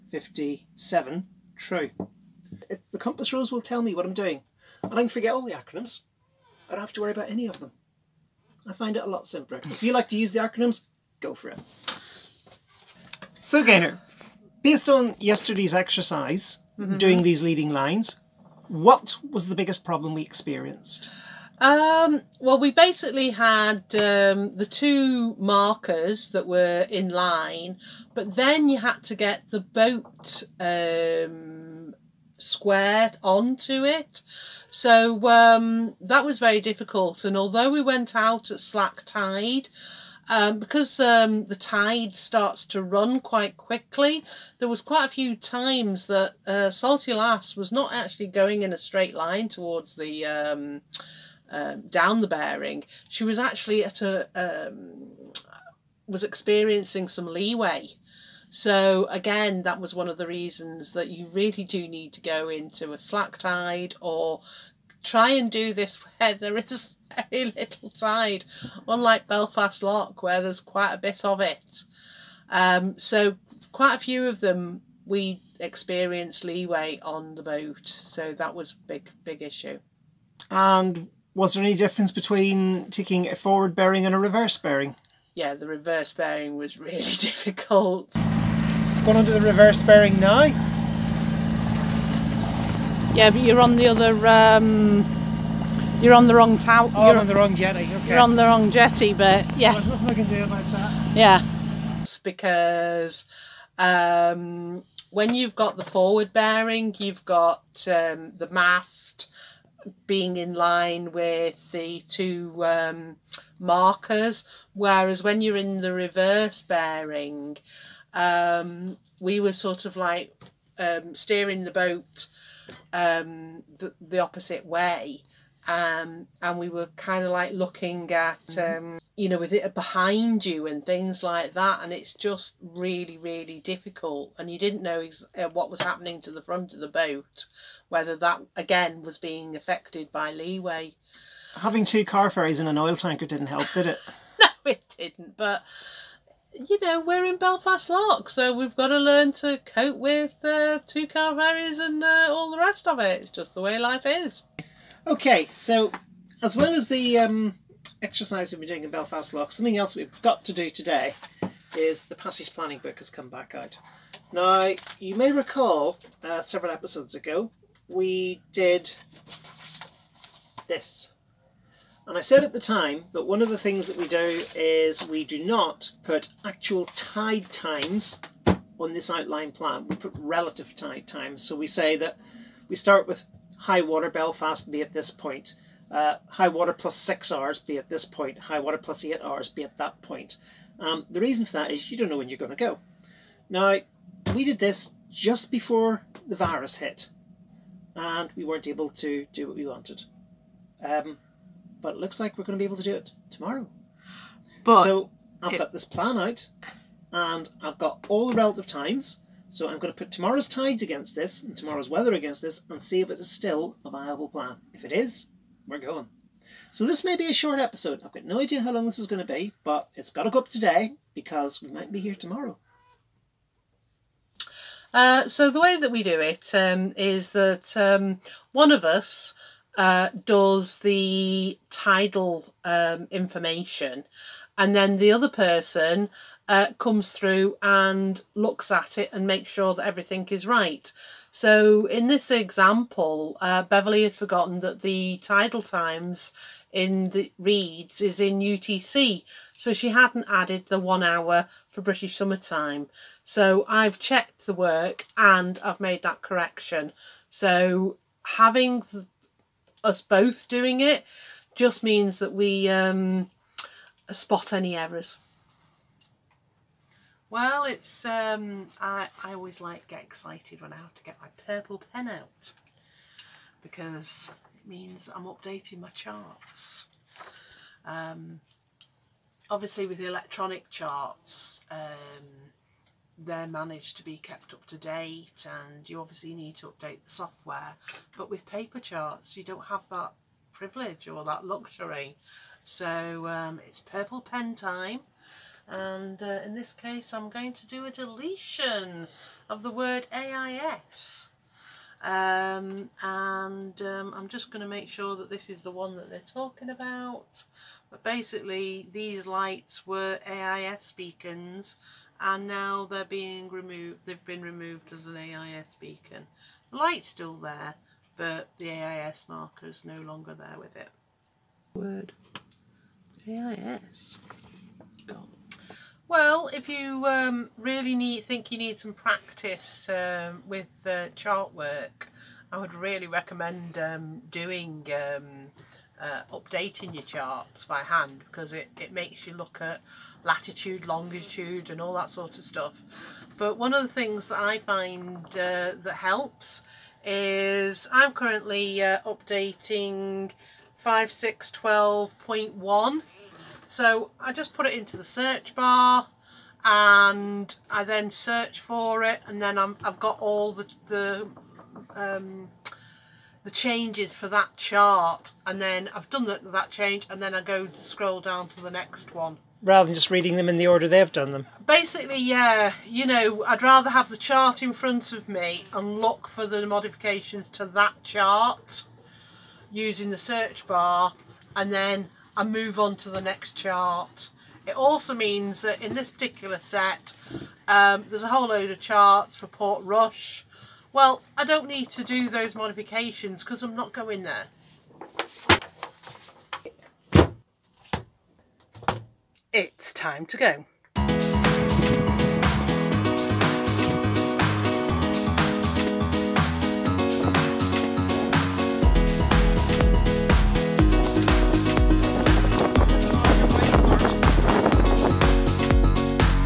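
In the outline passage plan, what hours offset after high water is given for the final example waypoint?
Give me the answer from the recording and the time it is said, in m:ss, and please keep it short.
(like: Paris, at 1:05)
8 hours, at 3:08.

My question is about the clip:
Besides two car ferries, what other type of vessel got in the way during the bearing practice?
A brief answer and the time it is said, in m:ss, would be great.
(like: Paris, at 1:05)
Oil tanker, at 2:22.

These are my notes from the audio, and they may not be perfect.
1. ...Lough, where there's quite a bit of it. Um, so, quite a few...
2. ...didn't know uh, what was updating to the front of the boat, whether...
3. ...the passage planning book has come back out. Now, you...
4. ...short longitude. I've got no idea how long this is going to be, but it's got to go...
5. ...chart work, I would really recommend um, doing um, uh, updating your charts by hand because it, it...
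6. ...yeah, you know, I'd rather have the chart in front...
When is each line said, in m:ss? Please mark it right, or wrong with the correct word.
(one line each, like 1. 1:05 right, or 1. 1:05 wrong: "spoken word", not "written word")
1. 1:09 right
2. 2:14 wrong: "happening", not "updating"
3. 2:42 right
4. 3:37 wrong: "episode", not "longitude"
5. 5:31 right
6. 6:12 right.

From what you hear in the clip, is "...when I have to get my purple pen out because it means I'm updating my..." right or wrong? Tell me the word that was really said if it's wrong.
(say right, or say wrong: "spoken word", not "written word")
right.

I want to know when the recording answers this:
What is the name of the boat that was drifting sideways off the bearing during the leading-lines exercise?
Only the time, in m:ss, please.
0:46.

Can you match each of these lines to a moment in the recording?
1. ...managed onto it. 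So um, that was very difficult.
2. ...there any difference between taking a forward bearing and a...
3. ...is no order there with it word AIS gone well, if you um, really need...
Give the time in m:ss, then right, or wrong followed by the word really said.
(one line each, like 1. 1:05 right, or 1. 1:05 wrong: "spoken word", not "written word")
1. 0:32 wrong: "squared", not "managed"
2. 1:21 right
3. 5:19 wrong: "longer", not "order".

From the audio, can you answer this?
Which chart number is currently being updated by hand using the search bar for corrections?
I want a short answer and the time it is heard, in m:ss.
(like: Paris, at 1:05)
5612.1, at 5:50.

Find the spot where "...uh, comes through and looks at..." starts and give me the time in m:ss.
3:56.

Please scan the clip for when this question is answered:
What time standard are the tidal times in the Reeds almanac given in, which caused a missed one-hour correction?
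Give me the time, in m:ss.
4:08.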